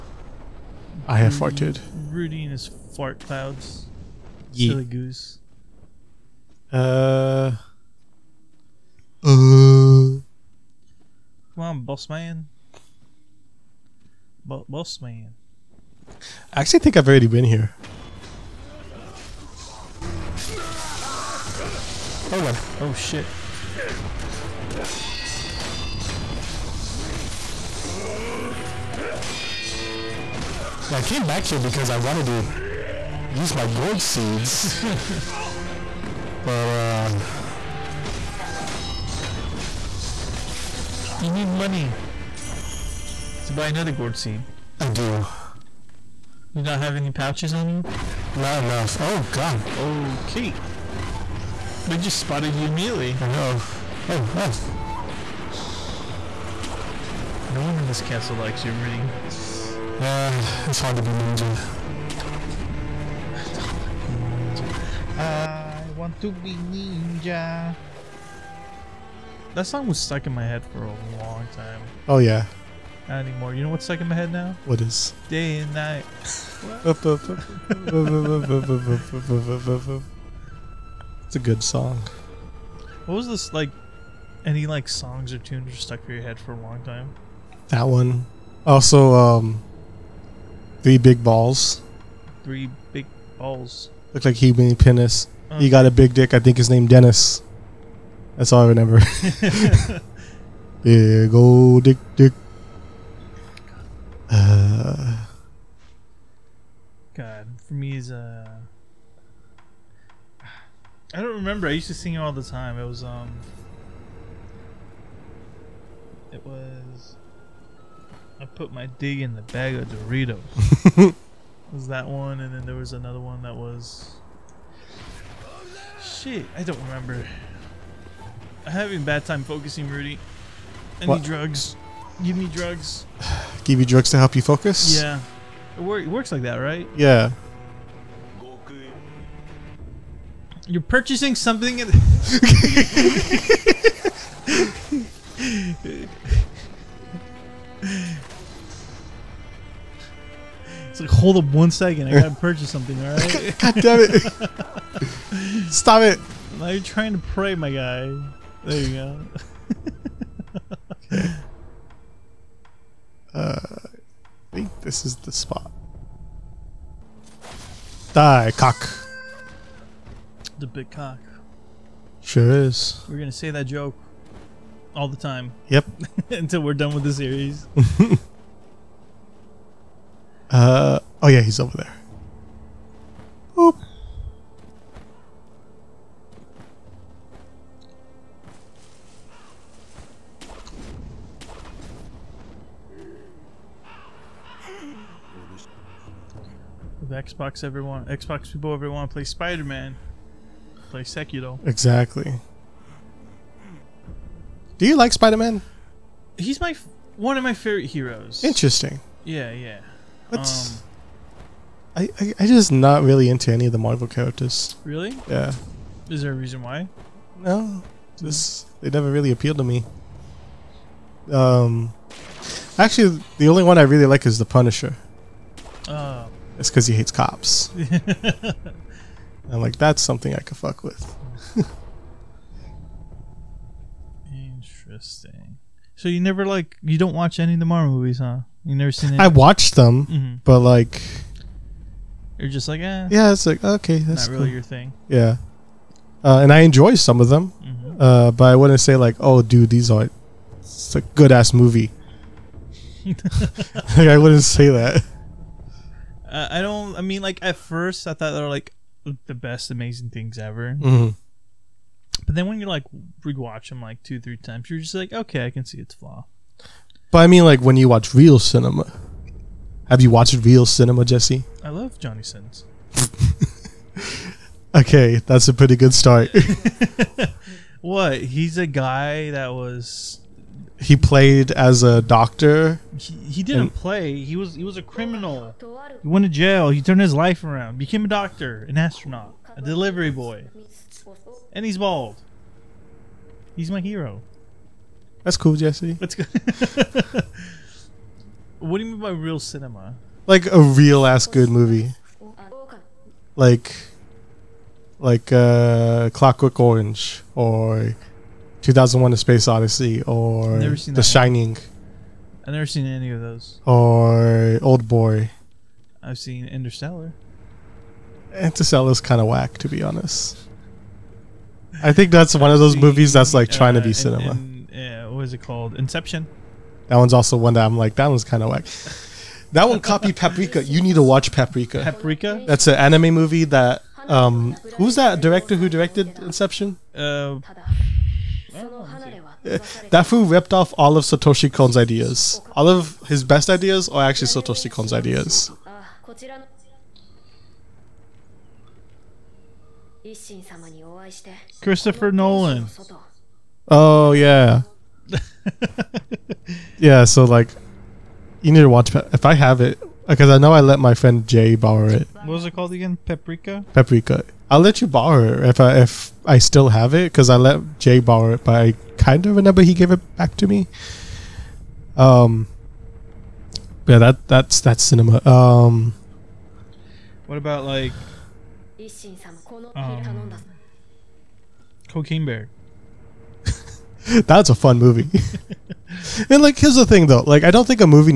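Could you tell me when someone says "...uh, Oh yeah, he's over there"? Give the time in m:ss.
3:00.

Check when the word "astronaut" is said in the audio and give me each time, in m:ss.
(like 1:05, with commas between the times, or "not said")
4:48.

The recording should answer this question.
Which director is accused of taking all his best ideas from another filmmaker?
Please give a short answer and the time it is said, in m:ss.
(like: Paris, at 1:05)
Christopher Nolan, at 5:51.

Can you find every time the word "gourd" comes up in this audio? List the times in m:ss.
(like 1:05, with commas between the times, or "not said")
0:33, 0:43.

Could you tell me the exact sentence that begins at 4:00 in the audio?
but like you're just like, eh.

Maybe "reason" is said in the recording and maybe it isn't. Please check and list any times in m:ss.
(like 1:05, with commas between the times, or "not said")
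3:36.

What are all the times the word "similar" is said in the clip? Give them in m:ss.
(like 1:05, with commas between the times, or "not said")
not said.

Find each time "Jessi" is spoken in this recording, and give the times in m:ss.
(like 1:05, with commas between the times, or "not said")
4:31, 4:55.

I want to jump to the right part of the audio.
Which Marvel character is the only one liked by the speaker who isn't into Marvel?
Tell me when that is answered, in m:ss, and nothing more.
3:44.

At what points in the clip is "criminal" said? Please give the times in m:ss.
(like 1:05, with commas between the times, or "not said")
4:44.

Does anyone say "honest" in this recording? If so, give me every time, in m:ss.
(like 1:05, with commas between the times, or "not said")
5:19.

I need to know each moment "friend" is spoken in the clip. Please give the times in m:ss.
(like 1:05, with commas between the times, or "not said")
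6:00.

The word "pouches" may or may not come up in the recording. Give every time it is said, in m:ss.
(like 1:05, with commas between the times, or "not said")
0:47.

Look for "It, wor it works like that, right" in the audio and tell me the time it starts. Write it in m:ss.
2:15.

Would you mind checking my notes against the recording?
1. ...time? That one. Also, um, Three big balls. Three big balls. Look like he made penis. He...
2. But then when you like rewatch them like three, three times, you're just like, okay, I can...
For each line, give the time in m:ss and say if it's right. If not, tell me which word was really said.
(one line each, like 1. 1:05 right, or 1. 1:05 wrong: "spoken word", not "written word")
1. 1:26 right
2. 4:22 wrong: "two", not "three".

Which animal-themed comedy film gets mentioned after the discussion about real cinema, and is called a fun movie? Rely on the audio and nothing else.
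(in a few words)
Cocaine Bear.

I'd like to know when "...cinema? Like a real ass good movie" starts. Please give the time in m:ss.
4:59.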